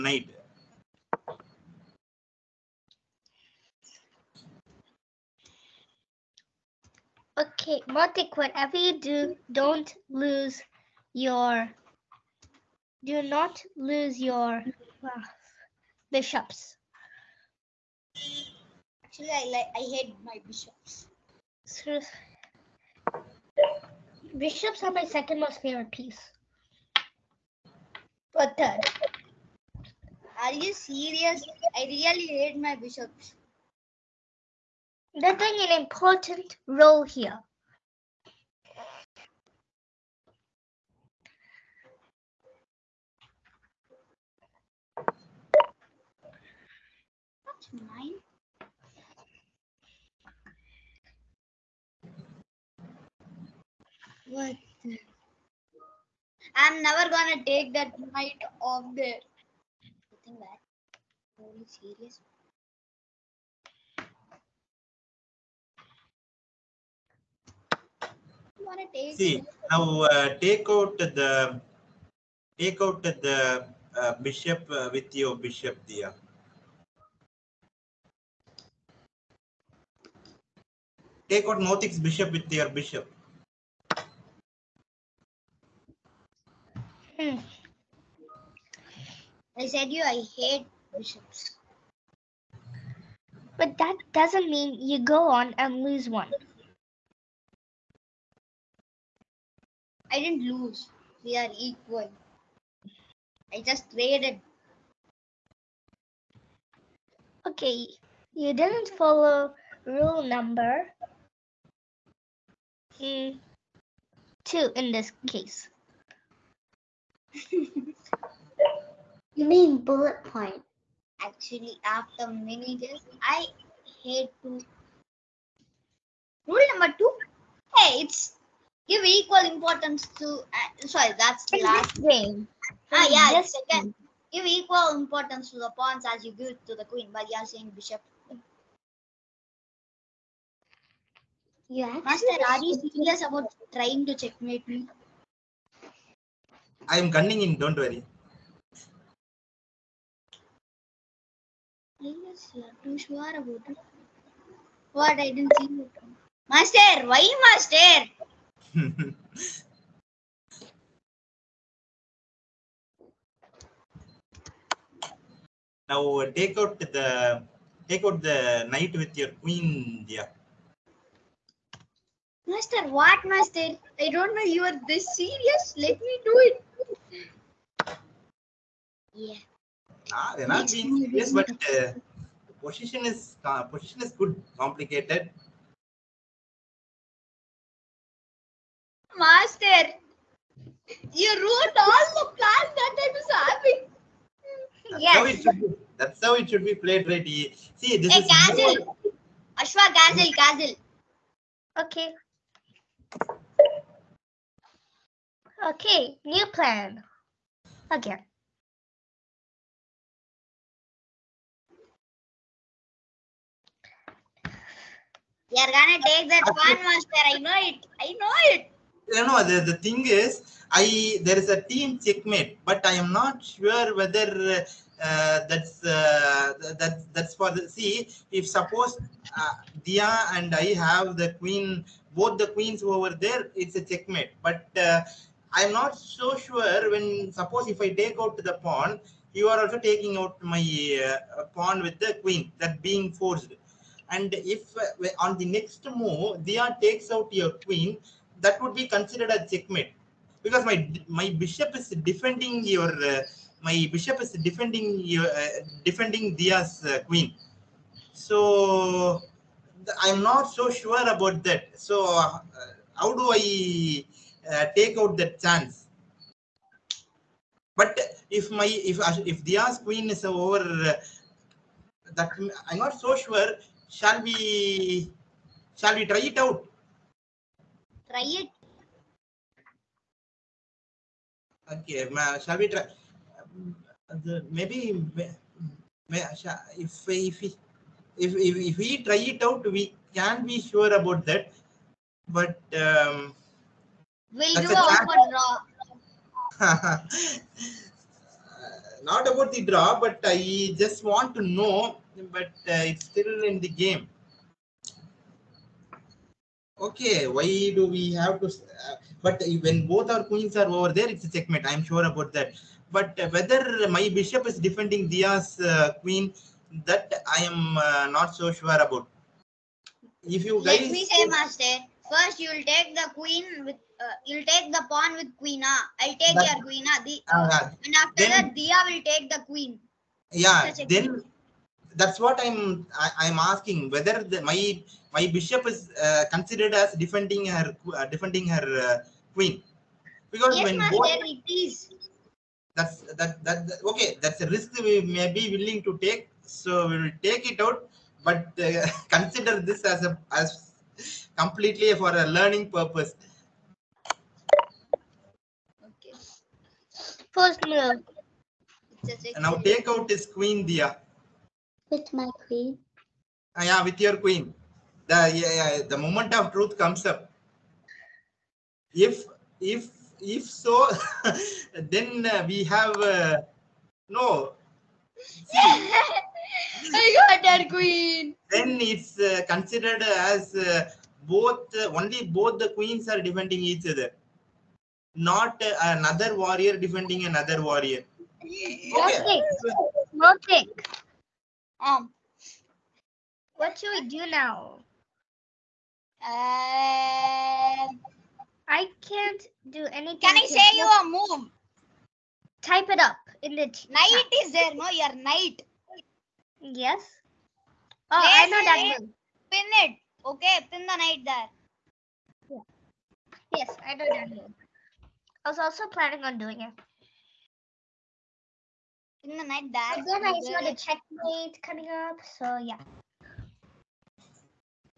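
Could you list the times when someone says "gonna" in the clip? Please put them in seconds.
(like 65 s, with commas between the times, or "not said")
57 s, 215 s.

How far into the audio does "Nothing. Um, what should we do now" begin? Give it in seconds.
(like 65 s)
390 s.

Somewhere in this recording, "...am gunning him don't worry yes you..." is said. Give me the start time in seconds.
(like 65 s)
147 s.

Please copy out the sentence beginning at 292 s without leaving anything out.
But um, we'll do a for draw.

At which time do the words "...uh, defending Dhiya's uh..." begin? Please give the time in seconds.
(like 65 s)
255 s.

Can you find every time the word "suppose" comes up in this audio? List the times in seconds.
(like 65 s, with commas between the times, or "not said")
228 s, 237 s.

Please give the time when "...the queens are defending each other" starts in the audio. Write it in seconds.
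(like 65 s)
382 s.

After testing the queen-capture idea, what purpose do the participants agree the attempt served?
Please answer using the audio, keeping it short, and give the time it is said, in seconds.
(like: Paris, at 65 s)
learning, at 351 s.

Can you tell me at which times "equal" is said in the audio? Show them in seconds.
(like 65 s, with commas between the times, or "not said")
101 s, 129 s, 134 s.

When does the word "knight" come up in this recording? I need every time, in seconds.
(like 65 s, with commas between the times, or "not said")
57 s, 168 s, 405 s, 410 s.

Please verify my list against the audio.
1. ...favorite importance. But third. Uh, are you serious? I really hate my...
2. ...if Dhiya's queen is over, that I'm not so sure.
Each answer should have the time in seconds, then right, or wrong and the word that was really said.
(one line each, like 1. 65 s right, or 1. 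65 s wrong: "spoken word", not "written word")
1. 25 s wrong: "piece", not "importance"
2. 269 s right.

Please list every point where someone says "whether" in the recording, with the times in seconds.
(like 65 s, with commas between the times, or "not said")
223 s, 313 s, 333 s.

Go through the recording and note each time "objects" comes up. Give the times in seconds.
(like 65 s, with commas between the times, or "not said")
not said.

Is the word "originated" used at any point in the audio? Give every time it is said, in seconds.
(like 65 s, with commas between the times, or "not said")
not said.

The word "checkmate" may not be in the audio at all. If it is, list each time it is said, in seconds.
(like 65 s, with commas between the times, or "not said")
144 s, 221 s, 233 s, 249 s, 311 s, 420 s.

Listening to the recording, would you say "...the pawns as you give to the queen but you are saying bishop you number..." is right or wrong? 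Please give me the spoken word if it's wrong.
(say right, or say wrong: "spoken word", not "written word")
wrong: "master", not "number".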